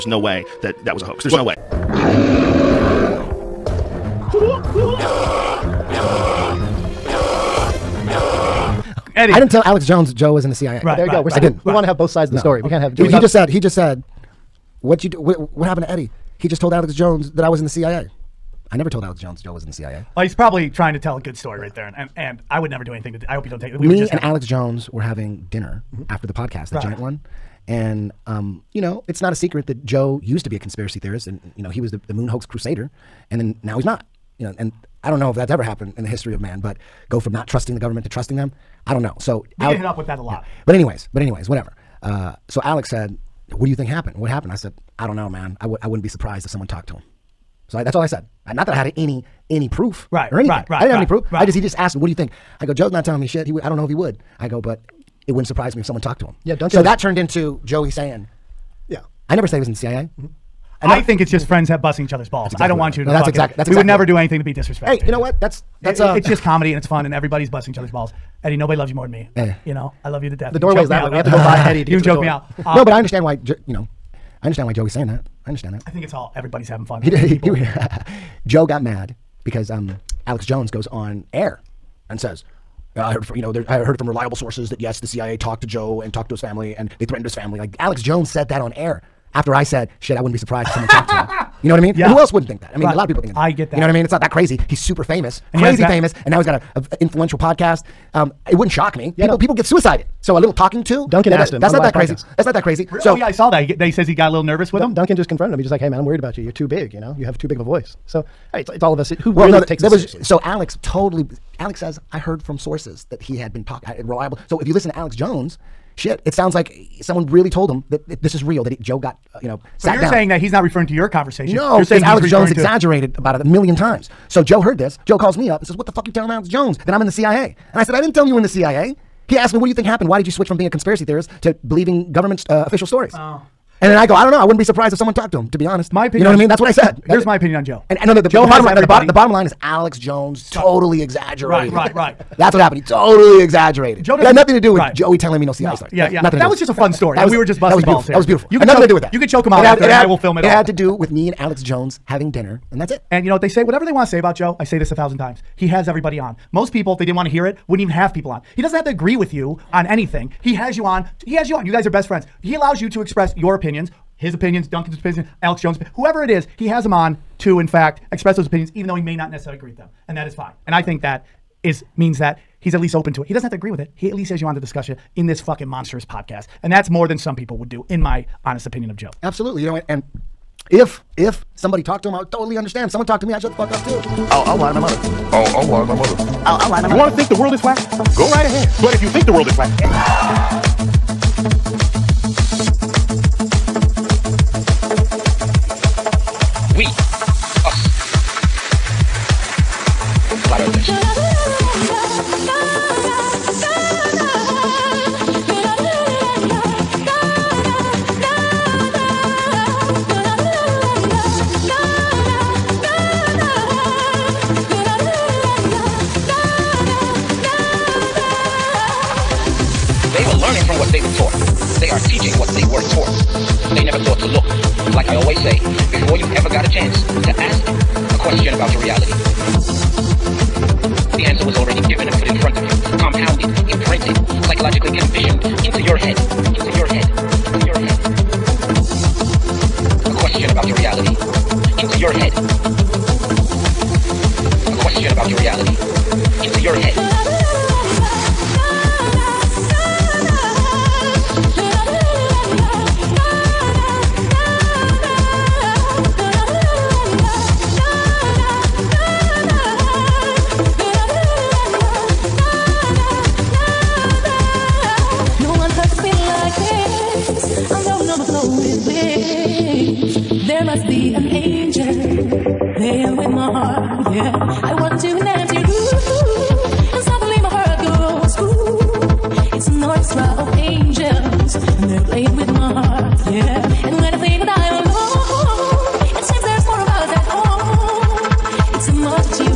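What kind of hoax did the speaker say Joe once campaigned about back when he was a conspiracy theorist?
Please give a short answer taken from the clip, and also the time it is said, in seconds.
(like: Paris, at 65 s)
moon hoax, at 32 s.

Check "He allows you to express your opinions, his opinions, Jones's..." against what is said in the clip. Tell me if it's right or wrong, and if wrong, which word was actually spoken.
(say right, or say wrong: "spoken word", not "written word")
wrong: "Duncan", not "Jones".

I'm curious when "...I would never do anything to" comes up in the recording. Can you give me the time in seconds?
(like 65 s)
22 s.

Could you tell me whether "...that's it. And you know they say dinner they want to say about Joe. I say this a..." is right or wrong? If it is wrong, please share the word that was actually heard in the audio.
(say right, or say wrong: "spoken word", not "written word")
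wrong: "whatever", not "dinner".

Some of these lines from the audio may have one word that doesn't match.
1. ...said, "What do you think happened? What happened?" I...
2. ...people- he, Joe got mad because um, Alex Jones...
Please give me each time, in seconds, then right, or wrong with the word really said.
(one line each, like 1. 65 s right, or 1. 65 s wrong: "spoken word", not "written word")
1. 42 s right
2. 77 s right.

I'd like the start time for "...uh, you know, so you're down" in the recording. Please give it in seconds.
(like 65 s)
119 s.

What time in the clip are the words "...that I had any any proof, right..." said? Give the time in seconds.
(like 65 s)
48 s.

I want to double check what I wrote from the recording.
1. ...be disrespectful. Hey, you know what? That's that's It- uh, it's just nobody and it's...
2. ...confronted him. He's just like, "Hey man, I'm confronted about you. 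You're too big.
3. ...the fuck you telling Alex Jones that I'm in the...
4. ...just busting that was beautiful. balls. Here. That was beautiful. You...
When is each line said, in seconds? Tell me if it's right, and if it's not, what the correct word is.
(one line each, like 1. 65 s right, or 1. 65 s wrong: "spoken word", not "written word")
1. 64 s wrong: "comedy", not "nobody"
2. 105 s wrong: "worried", not "confronted"
3. 125 s right
4. 147 s right.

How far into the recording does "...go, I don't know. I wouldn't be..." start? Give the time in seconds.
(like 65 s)
134 s.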